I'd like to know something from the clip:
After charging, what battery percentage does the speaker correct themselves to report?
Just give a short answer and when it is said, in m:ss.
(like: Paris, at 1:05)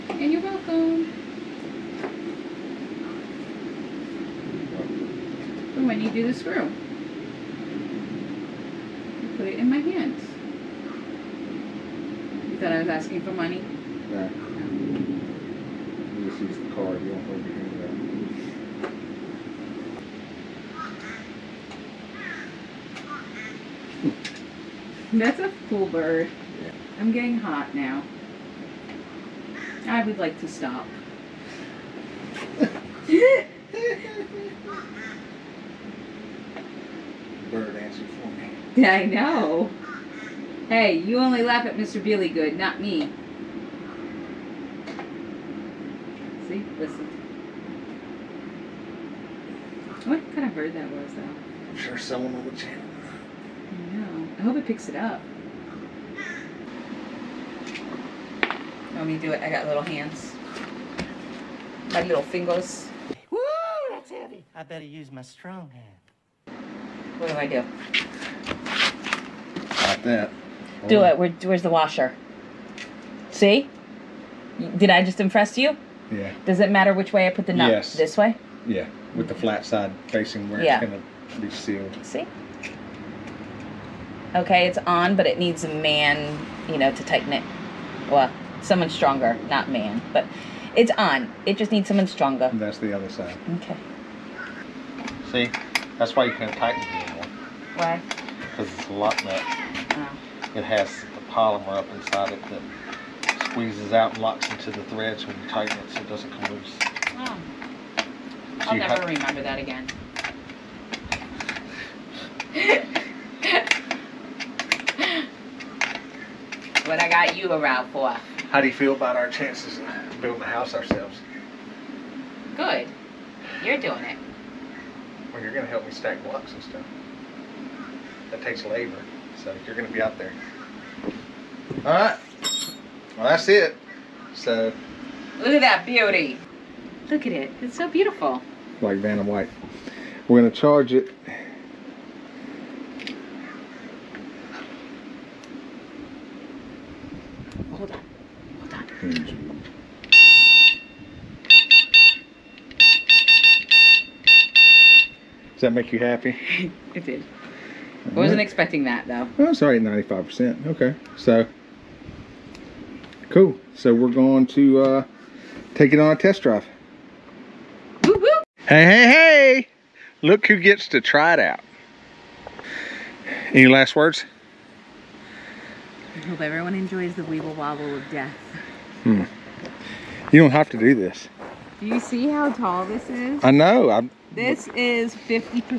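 95%, at 2:39.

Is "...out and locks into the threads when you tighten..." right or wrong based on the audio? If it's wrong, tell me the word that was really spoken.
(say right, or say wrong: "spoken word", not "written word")
right.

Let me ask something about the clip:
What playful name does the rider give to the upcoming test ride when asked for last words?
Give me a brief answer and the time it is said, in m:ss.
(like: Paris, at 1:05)
Weeble wobble of death, at 2:57.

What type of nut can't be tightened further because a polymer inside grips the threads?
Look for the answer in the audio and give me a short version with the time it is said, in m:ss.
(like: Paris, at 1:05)
Locked nut, at 1:38.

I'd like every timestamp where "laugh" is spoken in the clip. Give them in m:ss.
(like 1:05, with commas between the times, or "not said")
0:41.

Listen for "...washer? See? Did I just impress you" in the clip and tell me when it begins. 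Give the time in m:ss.
1:11.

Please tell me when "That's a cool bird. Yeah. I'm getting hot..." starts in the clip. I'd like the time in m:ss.
0:25.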